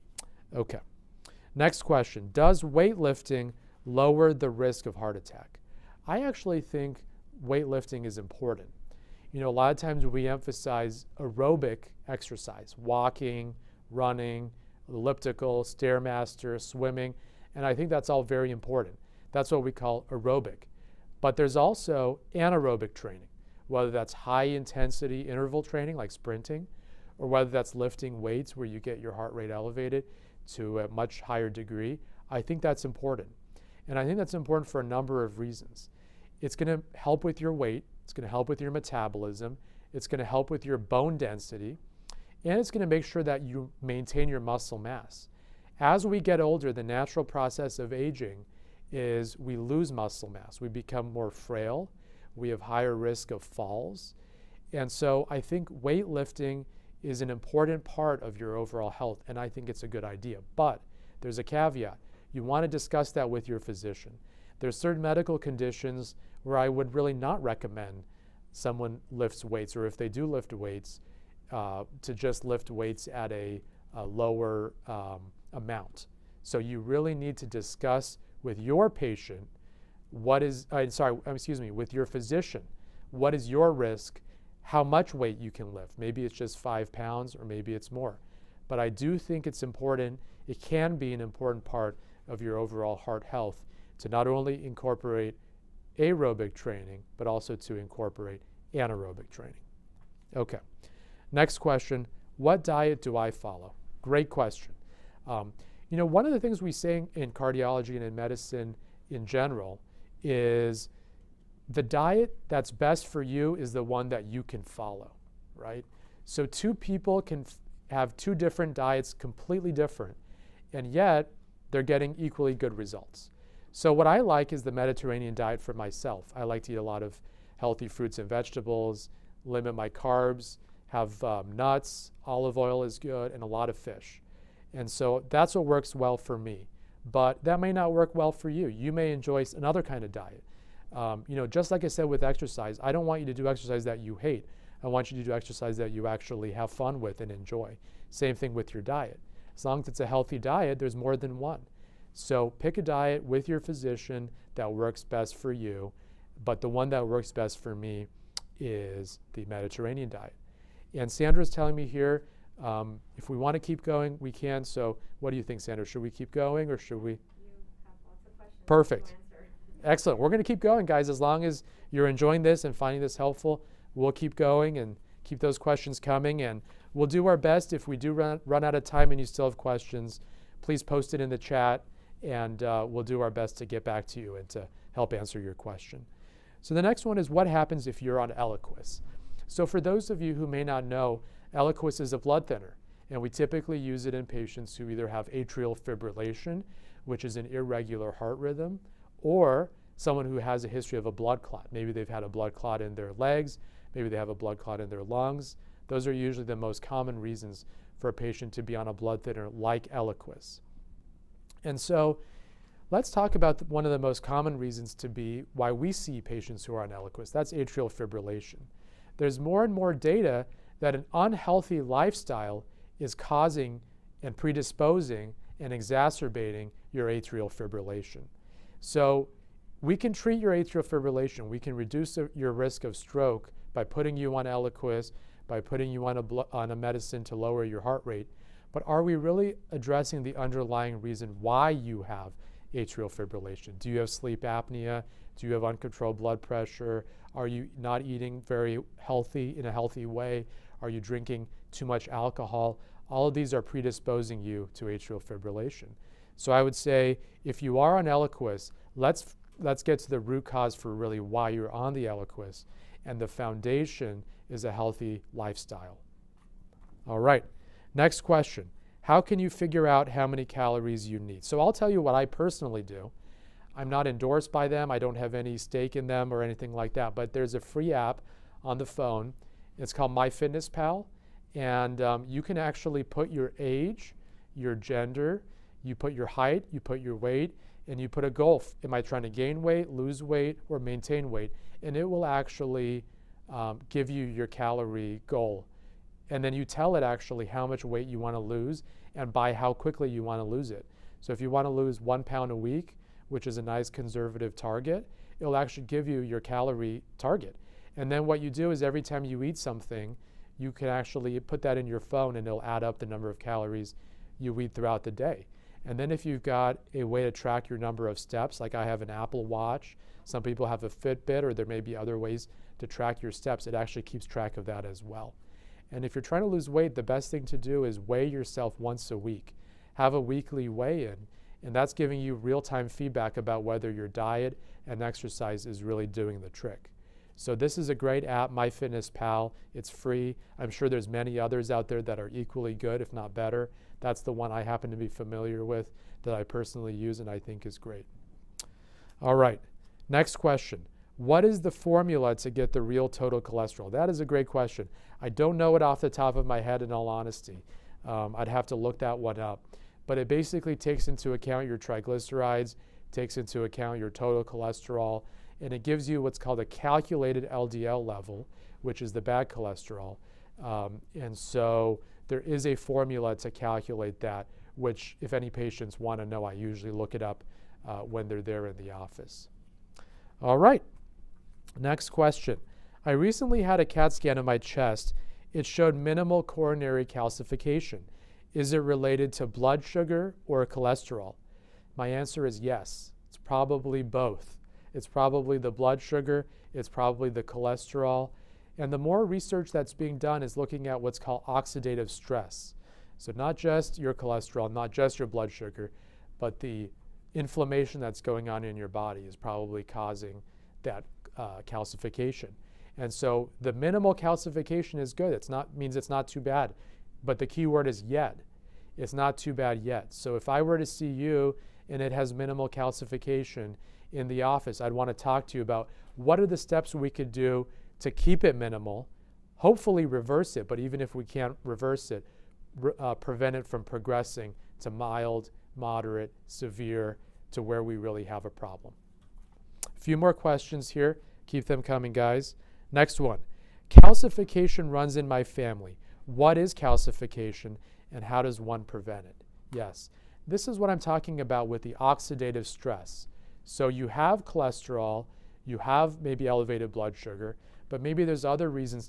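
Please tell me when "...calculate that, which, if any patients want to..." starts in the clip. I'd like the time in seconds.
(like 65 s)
373 s.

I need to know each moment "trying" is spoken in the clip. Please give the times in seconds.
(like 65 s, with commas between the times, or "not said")
289 s, 326 s.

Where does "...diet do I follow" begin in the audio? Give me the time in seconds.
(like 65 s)
102 s.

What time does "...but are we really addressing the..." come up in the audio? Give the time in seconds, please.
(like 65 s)
238 s.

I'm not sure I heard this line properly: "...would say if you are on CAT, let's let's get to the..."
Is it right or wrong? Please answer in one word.
wrong.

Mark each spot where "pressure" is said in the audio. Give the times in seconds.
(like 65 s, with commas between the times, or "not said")
246 s.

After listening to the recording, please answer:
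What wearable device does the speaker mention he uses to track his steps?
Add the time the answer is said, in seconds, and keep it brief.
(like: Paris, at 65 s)
Apple Watch, at 319 s.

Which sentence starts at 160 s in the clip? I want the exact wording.
And Sandra's telling me here, um, if we want to keep going, we can.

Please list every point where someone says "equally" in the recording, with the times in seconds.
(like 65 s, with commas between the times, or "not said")
122 s, 342 s.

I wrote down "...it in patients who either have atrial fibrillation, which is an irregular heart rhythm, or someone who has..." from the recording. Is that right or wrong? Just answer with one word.
right.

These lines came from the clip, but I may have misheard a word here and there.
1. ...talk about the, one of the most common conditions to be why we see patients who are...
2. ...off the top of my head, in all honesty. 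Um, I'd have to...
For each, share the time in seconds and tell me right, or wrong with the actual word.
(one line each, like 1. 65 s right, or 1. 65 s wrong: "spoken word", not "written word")
1. 213 s wrong: "reasons", not "conditions"
2. 355 s right.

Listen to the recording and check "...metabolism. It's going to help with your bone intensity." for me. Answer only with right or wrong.
wrong.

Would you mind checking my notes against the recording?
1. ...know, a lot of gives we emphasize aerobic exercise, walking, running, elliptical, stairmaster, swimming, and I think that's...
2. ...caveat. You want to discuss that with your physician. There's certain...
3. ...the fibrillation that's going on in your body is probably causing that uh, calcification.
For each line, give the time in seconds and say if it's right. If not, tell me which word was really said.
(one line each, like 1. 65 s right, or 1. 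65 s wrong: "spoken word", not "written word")
1. 9 s wrong: "times", not "gives"
2. 61 s right
3. 406 s wrong: "inflammation", not "fibrillation".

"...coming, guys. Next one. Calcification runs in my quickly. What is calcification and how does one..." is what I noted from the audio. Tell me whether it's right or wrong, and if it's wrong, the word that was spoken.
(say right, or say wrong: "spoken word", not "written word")
wrong: "family", not "quickly".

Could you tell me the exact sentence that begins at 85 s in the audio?
Maybe it's just five pounds or maybe it's more.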